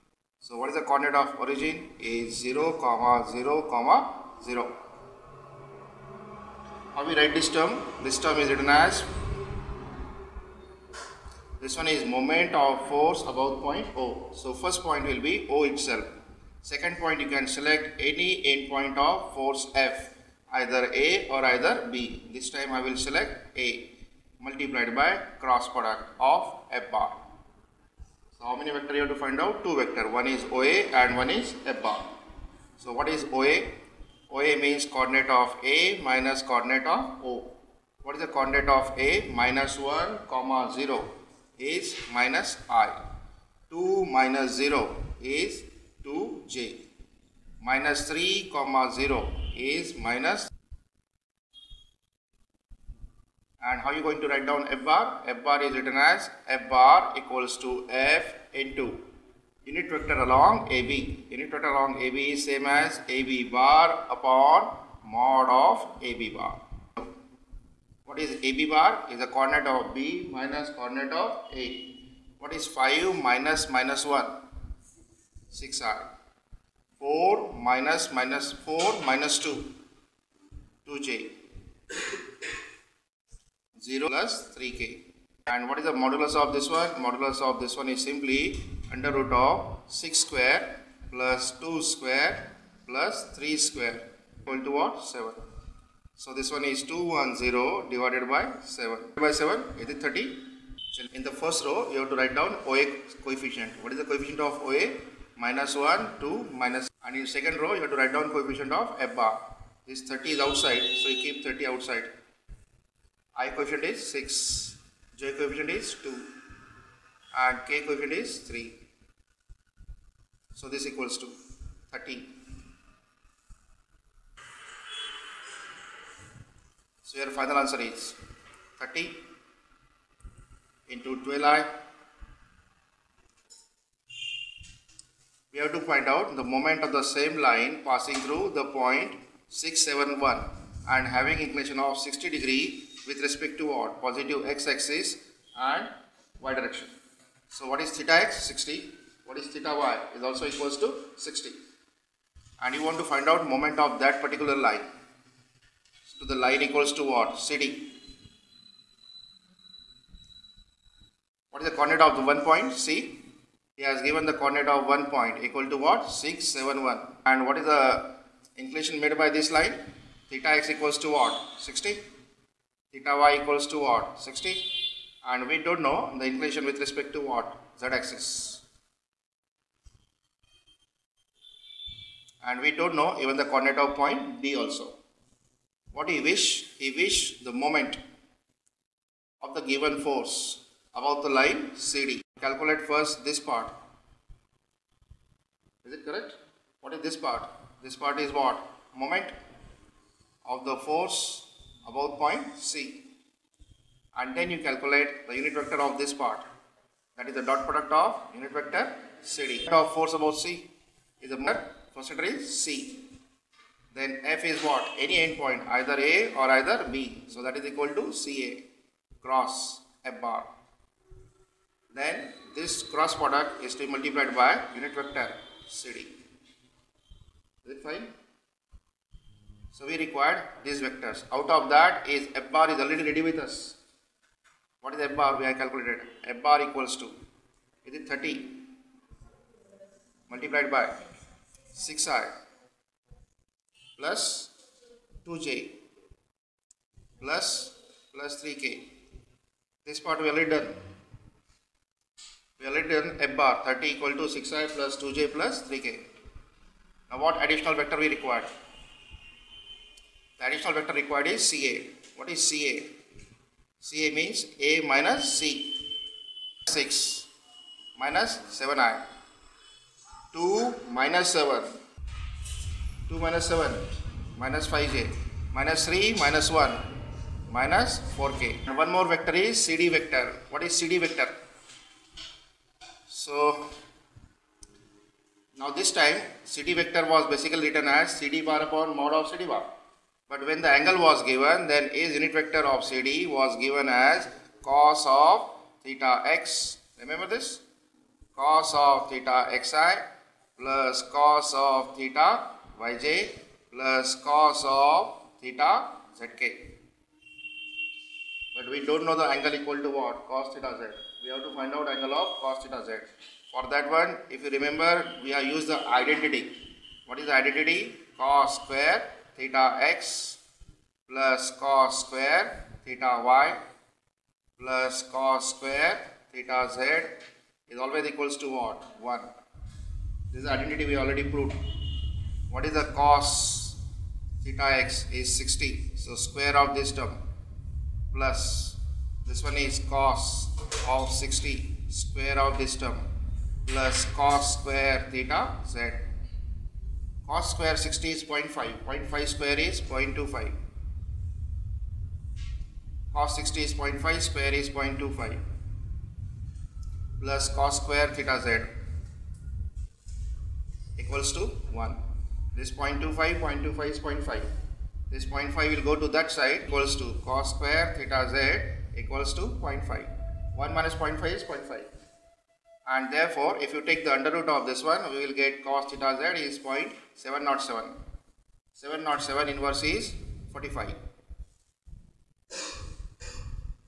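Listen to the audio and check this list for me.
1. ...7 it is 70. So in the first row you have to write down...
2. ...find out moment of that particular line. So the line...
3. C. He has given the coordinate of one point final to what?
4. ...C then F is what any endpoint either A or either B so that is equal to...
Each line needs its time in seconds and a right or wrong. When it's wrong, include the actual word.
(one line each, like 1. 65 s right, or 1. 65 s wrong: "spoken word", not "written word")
1. 99 s wrong: "30", not "70"
2. 153 s right
3. 162 s wrong: "equal", not "final"
4. 212 s right.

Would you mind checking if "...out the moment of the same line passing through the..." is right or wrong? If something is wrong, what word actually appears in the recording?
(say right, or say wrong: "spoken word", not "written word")
right.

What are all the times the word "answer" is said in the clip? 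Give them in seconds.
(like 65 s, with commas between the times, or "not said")
127 s.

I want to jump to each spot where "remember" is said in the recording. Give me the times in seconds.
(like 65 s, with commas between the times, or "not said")
296 s, 314 s.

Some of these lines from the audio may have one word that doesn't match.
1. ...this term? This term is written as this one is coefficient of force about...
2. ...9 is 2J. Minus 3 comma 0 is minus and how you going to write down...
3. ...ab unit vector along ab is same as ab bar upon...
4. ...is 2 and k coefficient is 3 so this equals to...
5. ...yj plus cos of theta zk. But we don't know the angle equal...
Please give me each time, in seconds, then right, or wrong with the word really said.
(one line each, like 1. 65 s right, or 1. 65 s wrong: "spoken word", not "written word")
1. 7 s wrong: "moment", not "coefficient"
2. 44 s wrong: "0", not "9"
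3. 60 s right
4. 115 s right
5. 302 s right.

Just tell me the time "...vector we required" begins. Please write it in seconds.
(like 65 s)
257 s.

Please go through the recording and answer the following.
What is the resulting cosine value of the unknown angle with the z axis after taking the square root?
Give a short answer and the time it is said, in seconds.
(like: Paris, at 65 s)
0.707, at 376 s.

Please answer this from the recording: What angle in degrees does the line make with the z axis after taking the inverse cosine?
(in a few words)
45.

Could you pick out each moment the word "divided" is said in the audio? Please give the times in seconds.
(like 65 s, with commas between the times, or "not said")
97 s.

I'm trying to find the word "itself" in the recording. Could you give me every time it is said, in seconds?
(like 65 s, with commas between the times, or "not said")
15 s.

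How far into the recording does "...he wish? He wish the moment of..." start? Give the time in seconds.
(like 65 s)
186 s.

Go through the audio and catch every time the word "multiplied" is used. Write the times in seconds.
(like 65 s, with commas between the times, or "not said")
24 s, 223 s, 240 s.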